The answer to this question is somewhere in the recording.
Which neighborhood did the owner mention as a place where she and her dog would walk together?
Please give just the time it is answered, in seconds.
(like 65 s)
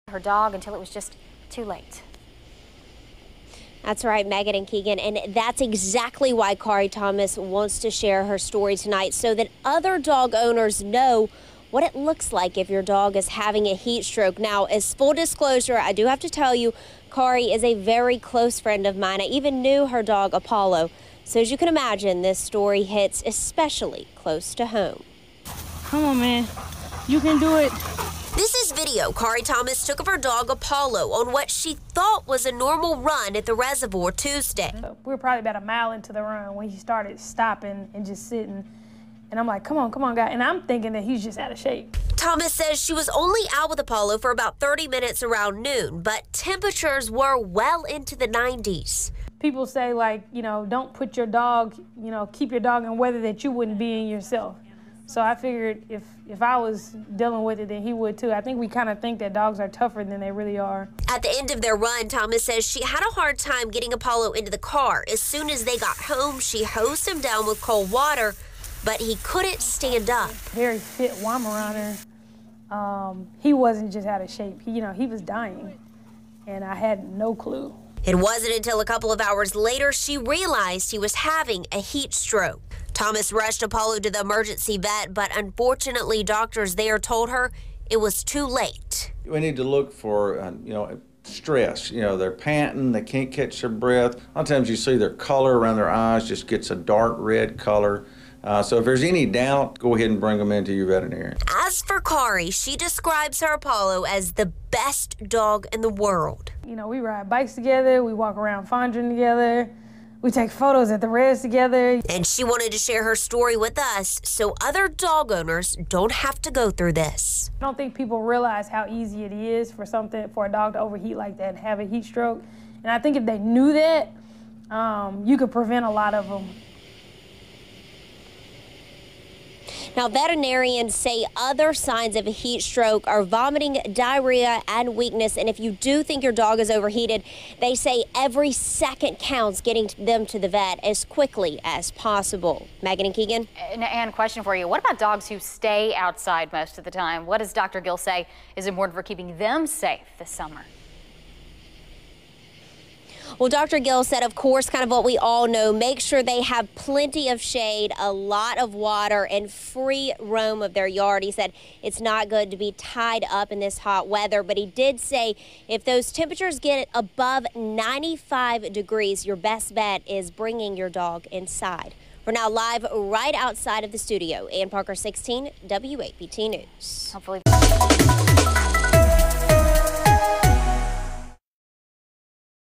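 108 s.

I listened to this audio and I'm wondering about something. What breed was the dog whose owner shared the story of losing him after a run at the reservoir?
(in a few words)
Weimaraner.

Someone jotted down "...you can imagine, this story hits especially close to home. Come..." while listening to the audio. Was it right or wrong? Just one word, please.
right.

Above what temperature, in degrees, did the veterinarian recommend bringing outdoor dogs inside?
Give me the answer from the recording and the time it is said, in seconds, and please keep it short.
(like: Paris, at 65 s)
95, at 167 s.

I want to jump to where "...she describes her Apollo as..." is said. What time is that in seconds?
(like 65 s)
102 s.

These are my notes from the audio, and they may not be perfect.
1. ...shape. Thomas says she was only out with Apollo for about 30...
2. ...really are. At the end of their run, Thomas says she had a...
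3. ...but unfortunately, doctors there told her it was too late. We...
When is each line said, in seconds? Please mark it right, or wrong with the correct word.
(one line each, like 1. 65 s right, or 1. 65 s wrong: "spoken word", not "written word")
1. 41 s right
2. 60 s right
3. 85 s right.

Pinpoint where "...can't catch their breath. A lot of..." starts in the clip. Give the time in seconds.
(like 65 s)
93 s.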